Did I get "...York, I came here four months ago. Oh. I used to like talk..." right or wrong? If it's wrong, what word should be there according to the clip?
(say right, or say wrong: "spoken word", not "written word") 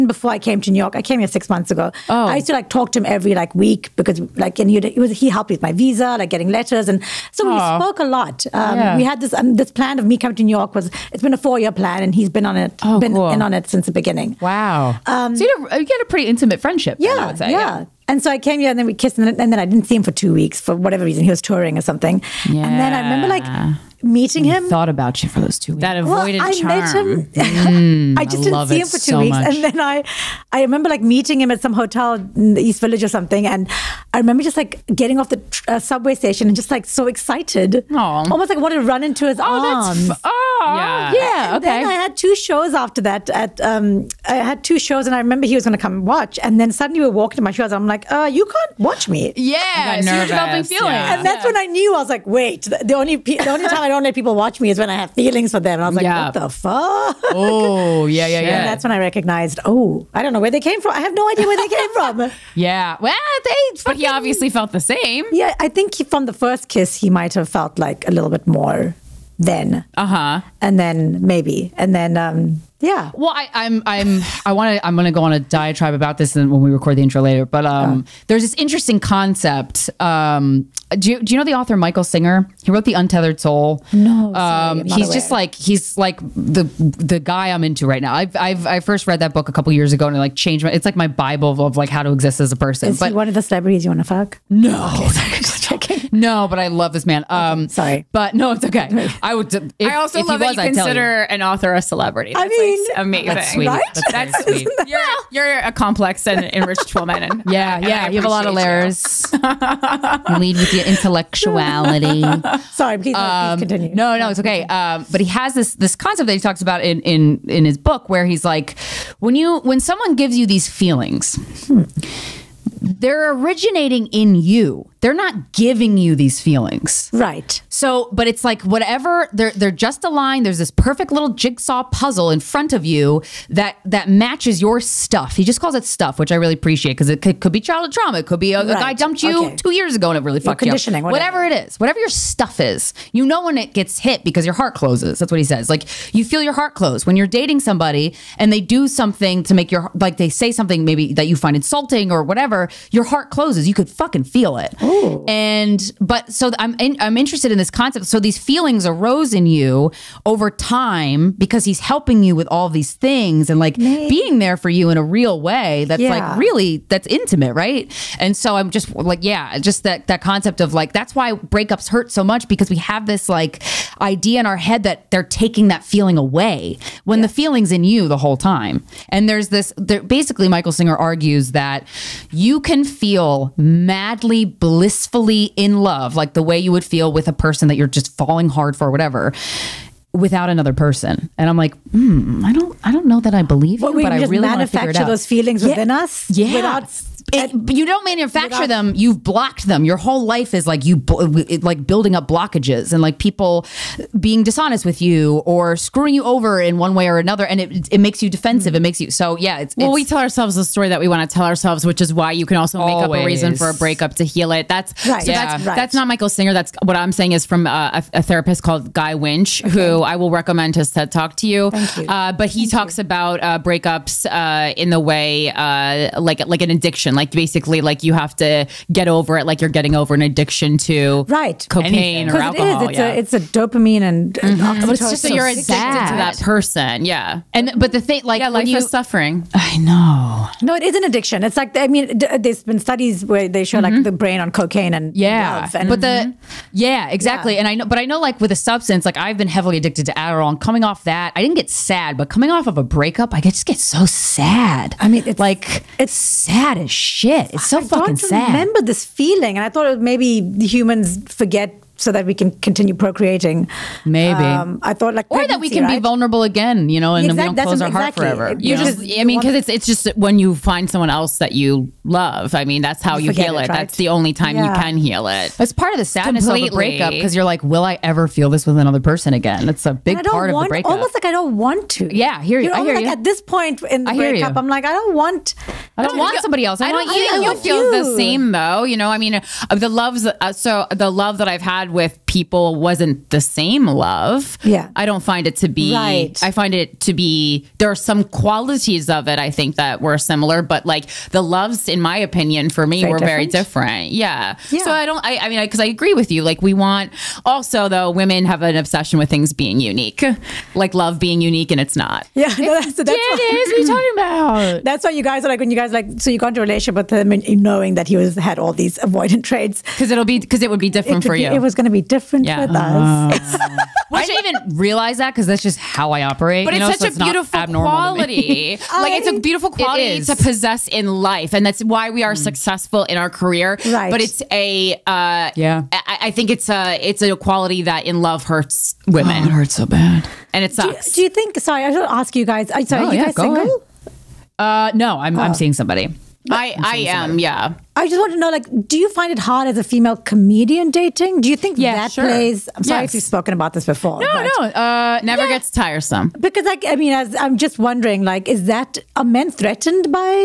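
wrong: "six", not "four".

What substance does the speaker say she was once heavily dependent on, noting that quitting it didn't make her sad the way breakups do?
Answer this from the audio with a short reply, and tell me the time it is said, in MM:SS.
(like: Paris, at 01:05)
Adderall, at 04:10.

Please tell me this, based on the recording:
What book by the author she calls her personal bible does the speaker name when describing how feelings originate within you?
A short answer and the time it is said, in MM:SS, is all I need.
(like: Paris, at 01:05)
The Untethered Soul, at 01:22.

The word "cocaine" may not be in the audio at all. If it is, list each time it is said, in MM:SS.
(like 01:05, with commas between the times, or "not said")
03:51, 04:04.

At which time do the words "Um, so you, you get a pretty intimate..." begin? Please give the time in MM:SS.
00:15.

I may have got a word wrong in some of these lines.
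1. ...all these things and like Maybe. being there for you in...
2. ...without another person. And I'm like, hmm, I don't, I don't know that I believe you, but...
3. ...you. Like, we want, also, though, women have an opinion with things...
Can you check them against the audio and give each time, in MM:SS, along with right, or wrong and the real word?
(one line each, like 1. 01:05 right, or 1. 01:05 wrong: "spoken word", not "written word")
1. 02:42 right
2. 03:10 right
3. 05:06 wrong: "obsession", not "opinion".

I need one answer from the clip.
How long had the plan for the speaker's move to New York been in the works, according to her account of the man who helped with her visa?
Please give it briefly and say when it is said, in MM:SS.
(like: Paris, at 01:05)
4 years, at 00:11.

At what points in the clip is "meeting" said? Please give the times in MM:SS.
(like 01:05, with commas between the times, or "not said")
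00:24, 00:31.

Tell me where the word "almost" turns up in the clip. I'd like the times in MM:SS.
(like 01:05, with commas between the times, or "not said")
00:38, 04:40.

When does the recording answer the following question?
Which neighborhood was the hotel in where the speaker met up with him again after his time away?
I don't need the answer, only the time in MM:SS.
00:32.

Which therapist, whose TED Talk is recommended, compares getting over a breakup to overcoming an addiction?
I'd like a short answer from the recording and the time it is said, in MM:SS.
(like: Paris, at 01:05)
Guy Winch, at 03:38.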